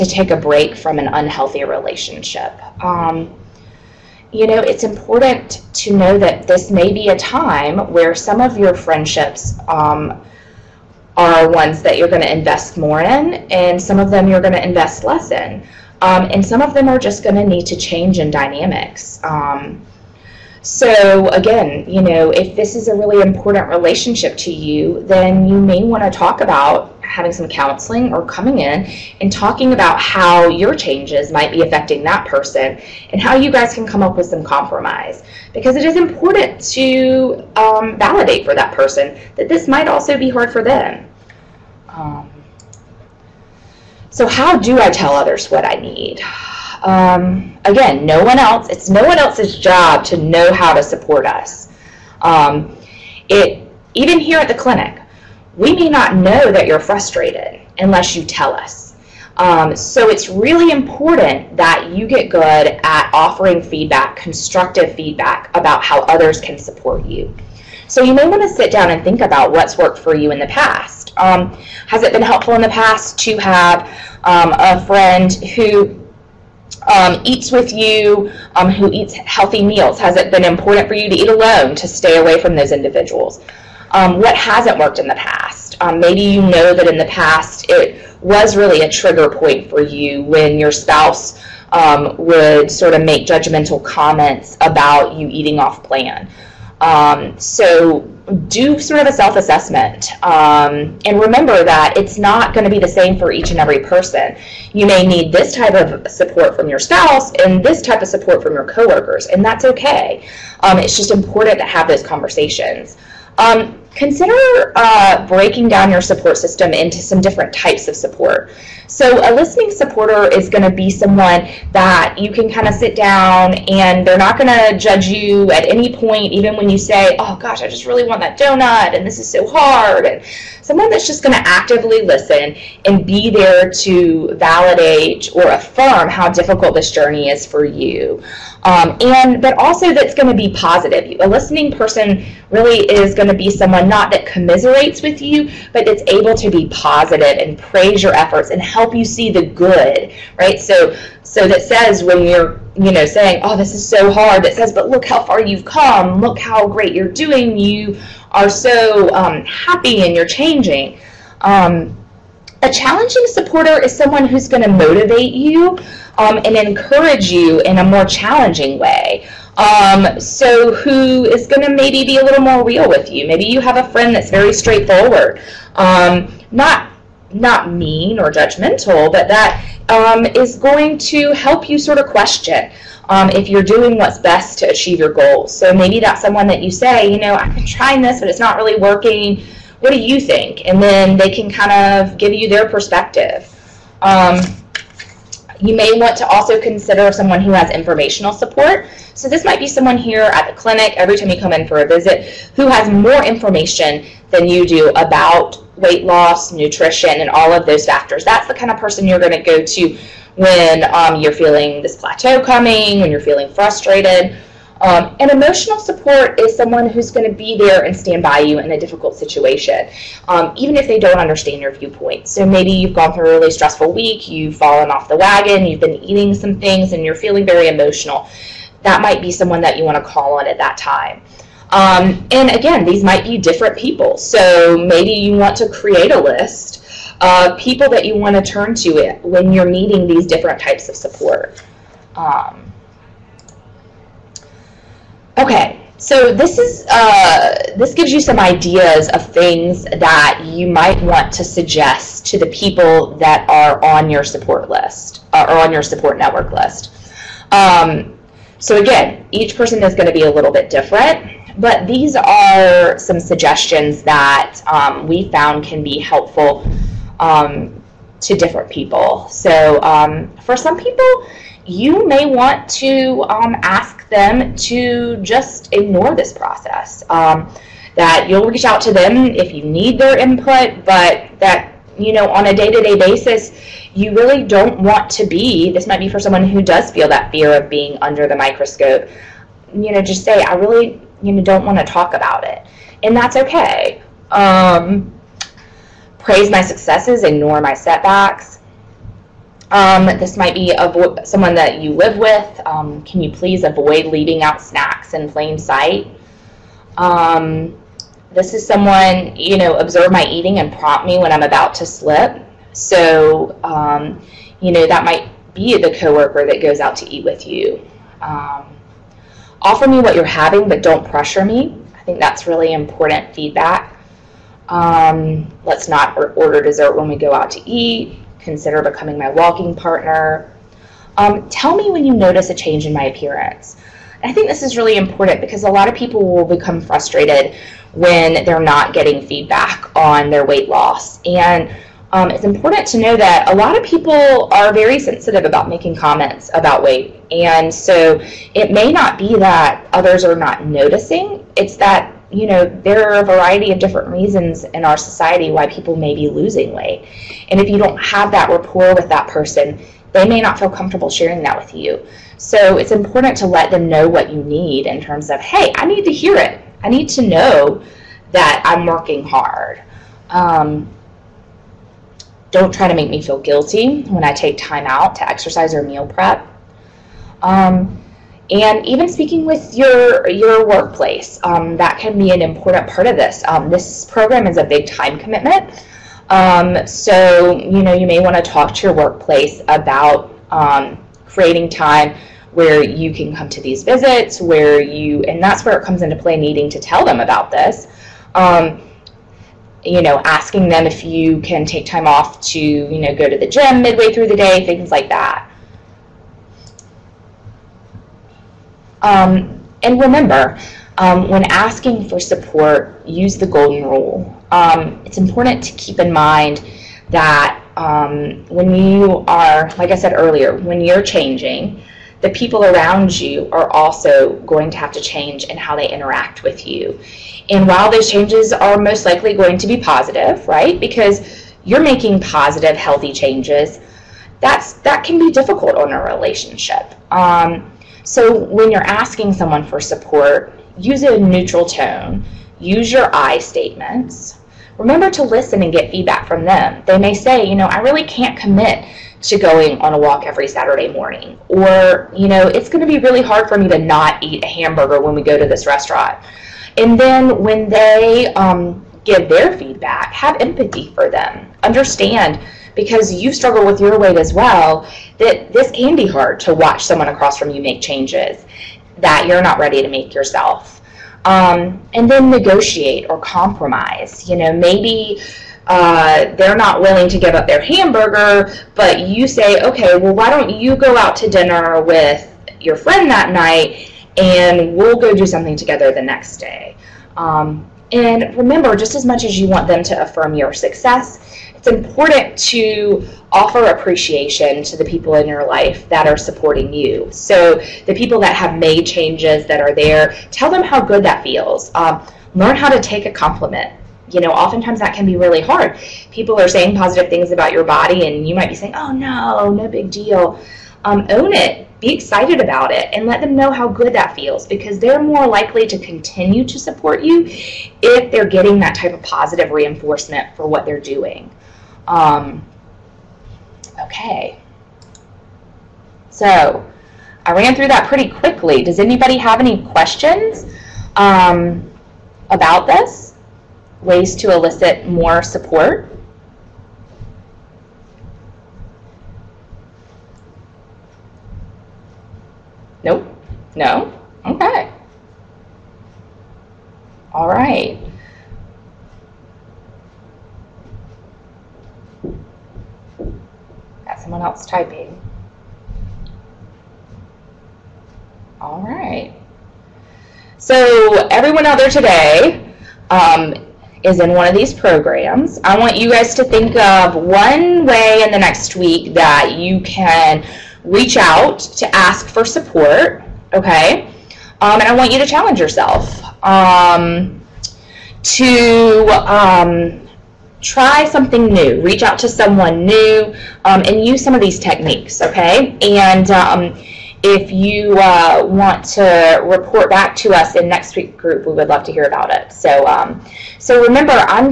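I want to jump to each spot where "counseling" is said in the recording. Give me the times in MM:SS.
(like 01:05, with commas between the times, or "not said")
00:27.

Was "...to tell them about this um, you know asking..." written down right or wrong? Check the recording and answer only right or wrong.
right.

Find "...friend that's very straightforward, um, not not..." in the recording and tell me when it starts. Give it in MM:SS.
02:53.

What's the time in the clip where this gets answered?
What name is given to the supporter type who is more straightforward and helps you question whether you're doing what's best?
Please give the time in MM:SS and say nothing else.
02:42.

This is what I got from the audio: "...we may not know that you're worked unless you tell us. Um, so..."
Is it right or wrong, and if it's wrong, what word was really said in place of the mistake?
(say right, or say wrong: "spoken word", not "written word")
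wrong: "frustrated", not "worked".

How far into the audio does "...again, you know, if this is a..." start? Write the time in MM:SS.
00:21.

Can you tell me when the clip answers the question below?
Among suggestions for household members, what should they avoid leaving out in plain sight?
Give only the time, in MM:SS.
05:04.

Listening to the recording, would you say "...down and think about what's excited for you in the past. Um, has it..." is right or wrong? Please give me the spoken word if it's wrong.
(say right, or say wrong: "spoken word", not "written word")
wrong: "worked", not "excited".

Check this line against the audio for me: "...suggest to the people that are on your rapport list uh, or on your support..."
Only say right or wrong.
wrong.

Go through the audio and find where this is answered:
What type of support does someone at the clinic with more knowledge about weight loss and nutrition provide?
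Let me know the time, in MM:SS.
03:17.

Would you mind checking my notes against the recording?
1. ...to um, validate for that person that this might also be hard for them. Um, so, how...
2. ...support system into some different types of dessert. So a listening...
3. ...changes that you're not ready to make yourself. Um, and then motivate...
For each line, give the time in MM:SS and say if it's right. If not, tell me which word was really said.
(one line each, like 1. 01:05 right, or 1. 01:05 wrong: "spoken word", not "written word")
1. 00:36 right
2. 01:56 wrong: "support", not "dessert"
3. 07:47 wrong: "negotiate", not "motivate".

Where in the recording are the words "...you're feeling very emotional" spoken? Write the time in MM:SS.
03:47.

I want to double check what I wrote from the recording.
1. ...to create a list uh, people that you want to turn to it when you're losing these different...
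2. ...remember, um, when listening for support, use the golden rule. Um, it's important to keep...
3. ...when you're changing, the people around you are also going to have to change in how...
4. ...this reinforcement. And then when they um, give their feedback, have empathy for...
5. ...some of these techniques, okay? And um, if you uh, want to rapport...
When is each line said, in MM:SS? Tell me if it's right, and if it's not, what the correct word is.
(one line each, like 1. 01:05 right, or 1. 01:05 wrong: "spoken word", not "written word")
1. 03:55 wrong: "needing", not "losing"
2. 06:50 wrong: "asking", not "listening"
3. 07:00 right
4. 07:35 wrong: "restaurant", not "reinforcement"
5. 09:44 wrong: "report", not "rapport".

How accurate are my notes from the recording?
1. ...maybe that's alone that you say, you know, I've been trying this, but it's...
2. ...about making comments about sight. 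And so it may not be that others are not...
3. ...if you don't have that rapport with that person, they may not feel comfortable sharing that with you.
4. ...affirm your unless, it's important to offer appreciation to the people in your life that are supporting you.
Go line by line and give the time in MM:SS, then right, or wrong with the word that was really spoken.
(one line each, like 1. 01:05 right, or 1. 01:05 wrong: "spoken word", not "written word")
1. 03:05 wrong: "someone", not "alone"
2. 05:45 wrong: "weight", not "sight"
3. 05:57 right
4. 08:10 wrong: "success", not "unless".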